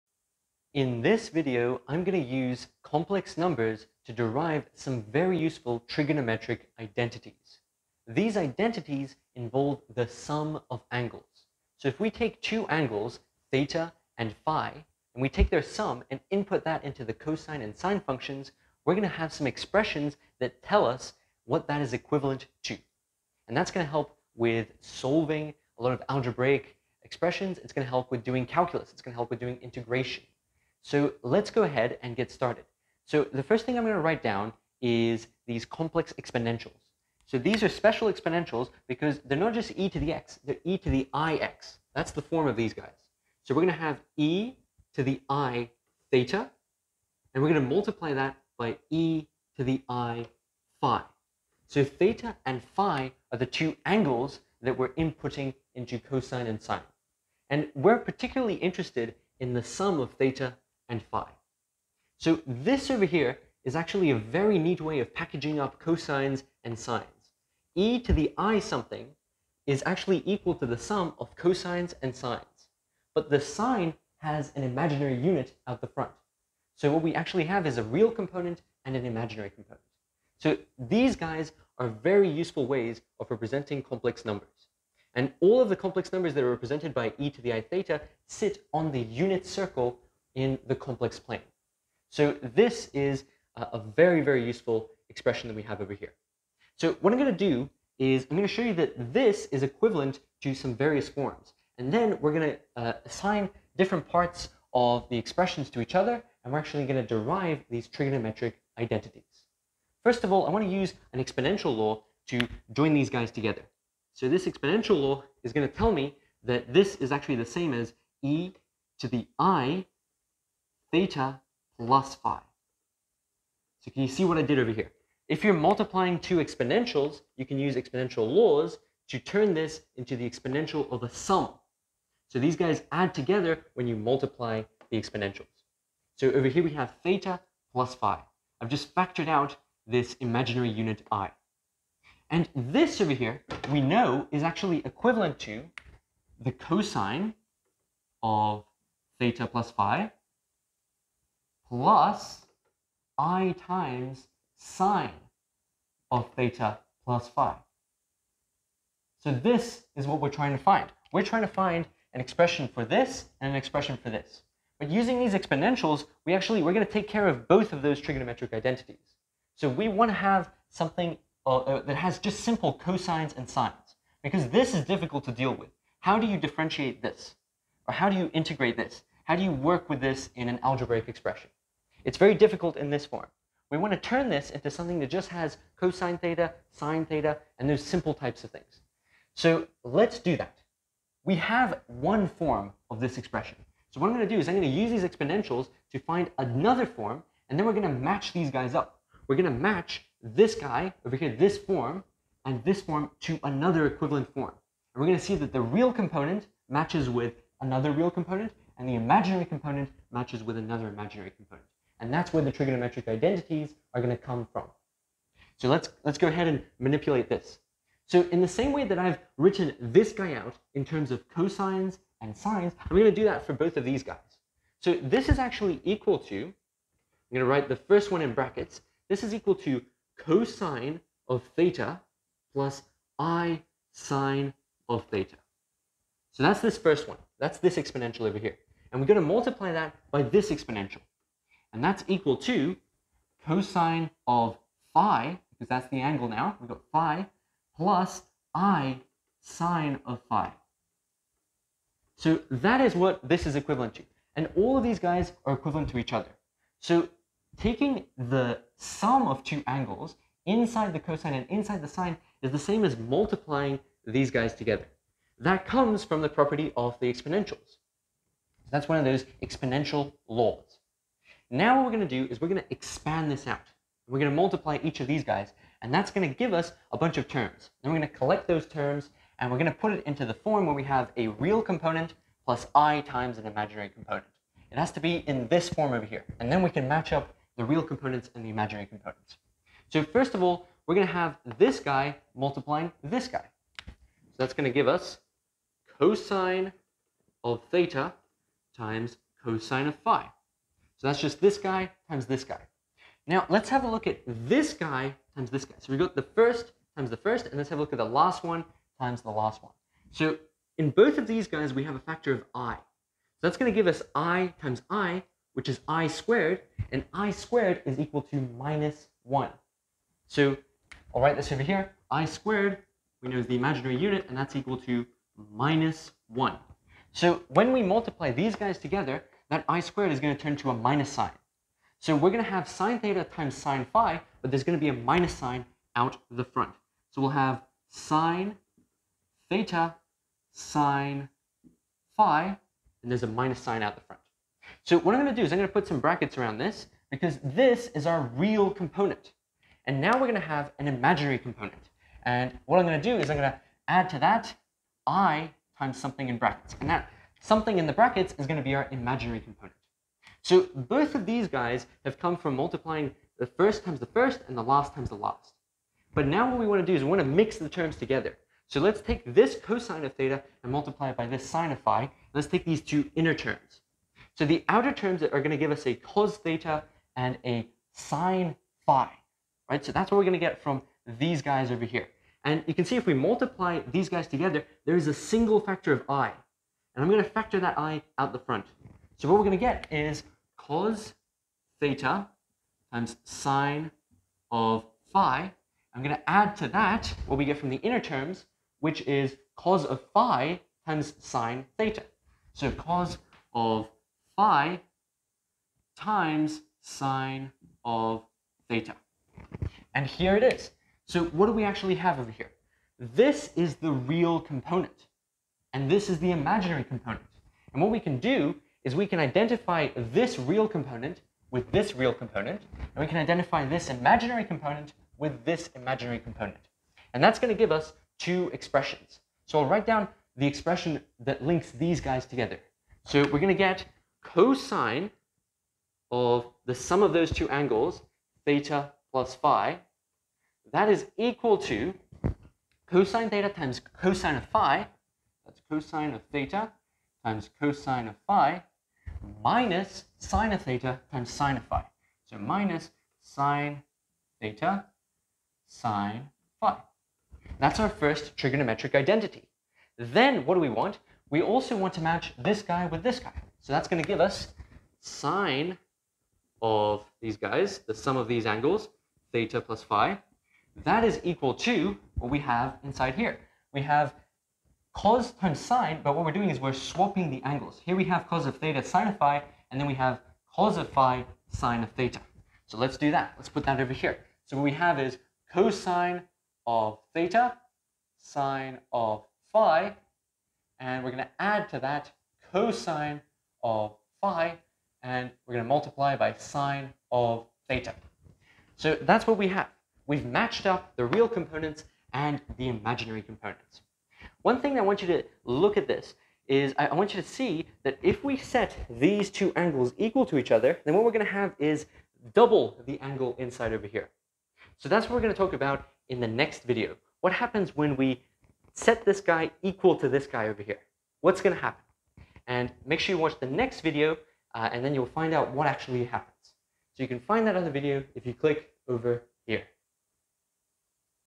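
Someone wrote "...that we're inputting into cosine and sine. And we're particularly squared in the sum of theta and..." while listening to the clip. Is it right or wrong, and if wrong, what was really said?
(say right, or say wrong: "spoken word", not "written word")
wrong: "interested", not "squared".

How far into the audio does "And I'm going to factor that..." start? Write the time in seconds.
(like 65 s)
386 s.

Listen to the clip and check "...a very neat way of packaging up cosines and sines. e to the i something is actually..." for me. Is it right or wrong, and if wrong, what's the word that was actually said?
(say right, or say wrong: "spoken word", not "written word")
right.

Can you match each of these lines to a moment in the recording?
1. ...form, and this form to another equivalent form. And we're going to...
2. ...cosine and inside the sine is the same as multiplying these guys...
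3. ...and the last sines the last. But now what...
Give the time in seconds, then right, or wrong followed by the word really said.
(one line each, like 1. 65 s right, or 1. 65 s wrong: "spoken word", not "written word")
1. 201 s right
2. 260 s right
3. 364 s wrong: "times", not "sines".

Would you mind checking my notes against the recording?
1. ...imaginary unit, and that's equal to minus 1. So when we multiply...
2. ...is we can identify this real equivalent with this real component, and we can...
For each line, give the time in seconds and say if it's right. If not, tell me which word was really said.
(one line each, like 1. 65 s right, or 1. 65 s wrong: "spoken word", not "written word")
1. 323 s right
2. 418 s wrong: "component", not "equivalent".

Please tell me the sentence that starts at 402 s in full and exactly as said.
So cos of phi times sine of theta.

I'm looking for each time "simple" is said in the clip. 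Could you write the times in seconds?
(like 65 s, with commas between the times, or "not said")
172 s, 187 s.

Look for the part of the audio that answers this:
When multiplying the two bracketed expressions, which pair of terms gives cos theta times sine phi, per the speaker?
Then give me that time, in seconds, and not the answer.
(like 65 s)
374 s.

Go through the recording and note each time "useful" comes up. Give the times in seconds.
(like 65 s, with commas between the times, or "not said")
5 s, 82 s, 94 s.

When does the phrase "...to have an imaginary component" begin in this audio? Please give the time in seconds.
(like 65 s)
350 s.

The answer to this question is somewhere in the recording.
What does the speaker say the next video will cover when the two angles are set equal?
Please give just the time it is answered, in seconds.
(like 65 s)
512 s.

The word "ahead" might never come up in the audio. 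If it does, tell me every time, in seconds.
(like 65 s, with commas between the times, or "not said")
31 s, 216 s.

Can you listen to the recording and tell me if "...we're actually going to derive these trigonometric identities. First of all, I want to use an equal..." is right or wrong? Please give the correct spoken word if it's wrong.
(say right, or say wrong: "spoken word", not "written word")
wrong: "exponential", not "equal".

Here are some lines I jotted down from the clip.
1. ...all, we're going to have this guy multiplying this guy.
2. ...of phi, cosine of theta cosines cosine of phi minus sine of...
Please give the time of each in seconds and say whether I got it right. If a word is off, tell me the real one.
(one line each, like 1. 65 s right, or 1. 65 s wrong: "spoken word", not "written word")
1. 290 s right
2. 444 s wrong: "times", not "cosines".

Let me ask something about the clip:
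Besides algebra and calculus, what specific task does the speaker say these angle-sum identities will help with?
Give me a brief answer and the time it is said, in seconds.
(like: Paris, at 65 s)
integration, at 29 s.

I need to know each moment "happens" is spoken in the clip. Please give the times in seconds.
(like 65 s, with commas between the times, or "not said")
517 s, 521 s, 526 s.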